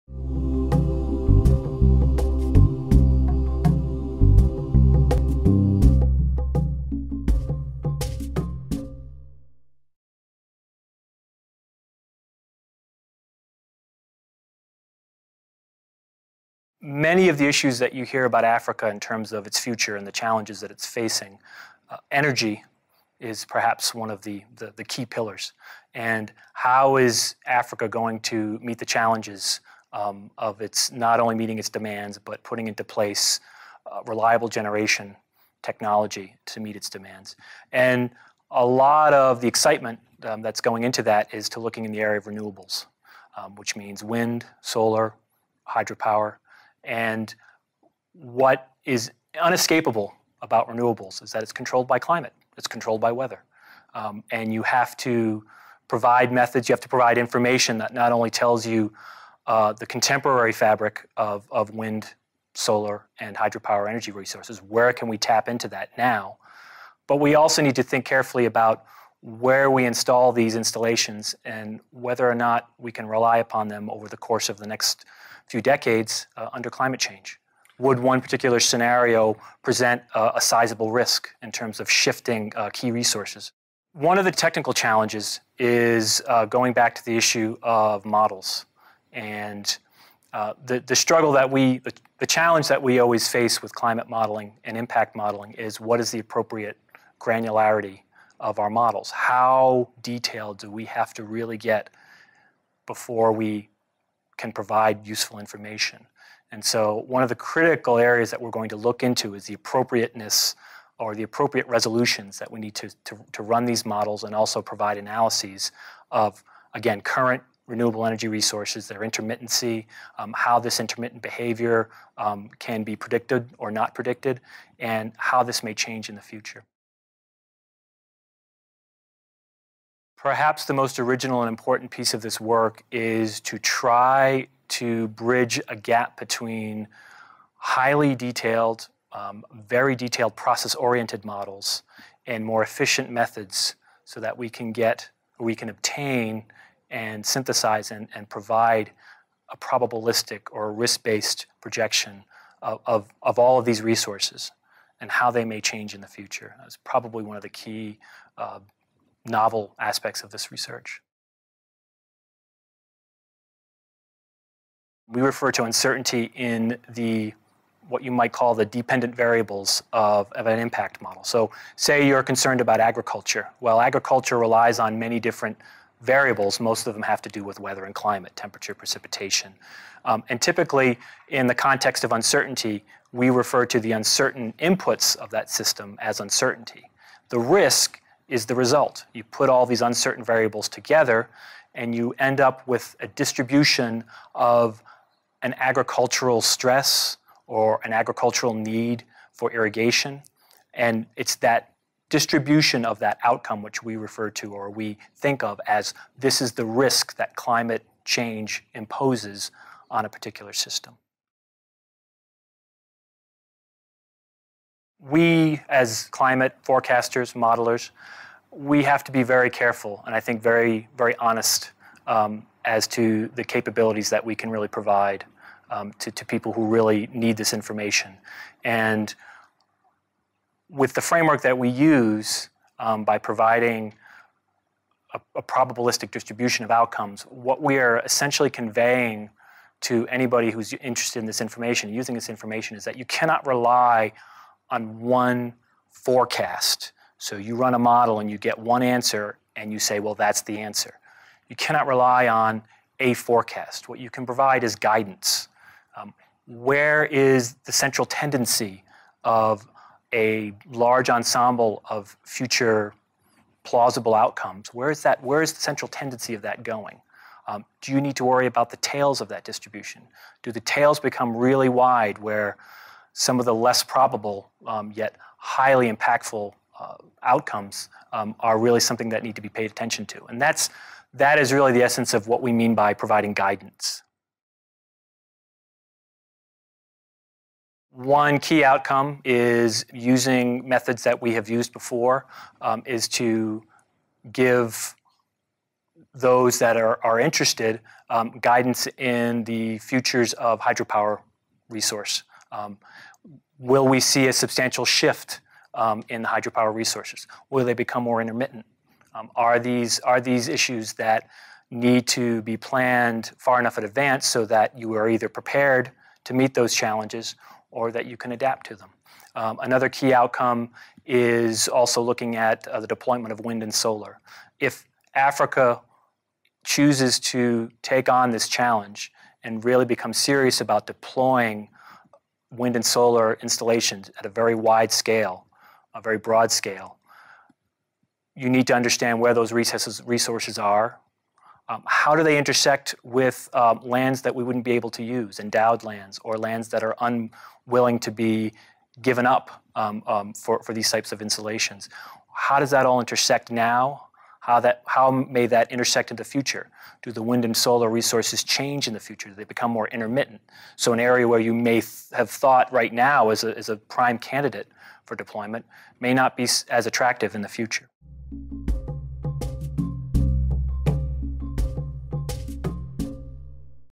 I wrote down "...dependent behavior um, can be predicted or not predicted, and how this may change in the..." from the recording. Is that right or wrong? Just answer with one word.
wrong.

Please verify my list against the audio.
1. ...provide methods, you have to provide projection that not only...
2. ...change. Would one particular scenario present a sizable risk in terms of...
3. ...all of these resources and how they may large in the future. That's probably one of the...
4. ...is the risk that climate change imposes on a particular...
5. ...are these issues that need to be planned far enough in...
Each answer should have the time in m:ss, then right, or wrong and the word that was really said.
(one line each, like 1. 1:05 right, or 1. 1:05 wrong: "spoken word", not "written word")
1. 0:55 wrong: "information", not "projection"
2. 1:16 right
3. 2:33 wrong: "change", not "large"
4. 3:26 right
5. 5:09 right.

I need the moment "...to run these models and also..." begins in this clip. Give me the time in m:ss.
1:53.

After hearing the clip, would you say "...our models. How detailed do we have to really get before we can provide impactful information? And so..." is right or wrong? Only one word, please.
wrong.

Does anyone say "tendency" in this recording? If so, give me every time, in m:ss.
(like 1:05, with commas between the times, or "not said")
4:18, 4:25.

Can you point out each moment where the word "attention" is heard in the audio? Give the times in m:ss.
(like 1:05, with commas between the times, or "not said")
4:39.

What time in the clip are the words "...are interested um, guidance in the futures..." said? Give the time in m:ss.
4:57.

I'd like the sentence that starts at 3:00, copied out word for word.
Um, and typically, in the context of uncertainty, we refer to the uncertain inputs of that system as uncertainty.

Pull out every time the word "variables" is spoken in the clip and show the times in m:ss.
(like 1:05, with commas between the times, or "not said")
2:49, 2:55, 3:10.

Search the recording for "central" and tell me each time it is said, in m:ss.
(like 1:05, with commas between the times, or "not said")
4:17, 4:25.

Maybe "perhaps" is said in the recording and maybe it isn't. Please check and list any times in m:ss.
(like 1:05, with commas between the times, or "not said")
0:23, 2:10.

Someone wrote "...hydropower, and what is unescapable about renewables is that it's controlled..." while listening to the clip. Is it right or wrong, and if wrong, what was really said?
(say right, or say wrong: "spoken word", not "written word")
right.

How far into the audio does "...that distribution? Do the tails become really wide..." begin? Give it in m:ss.
4:29.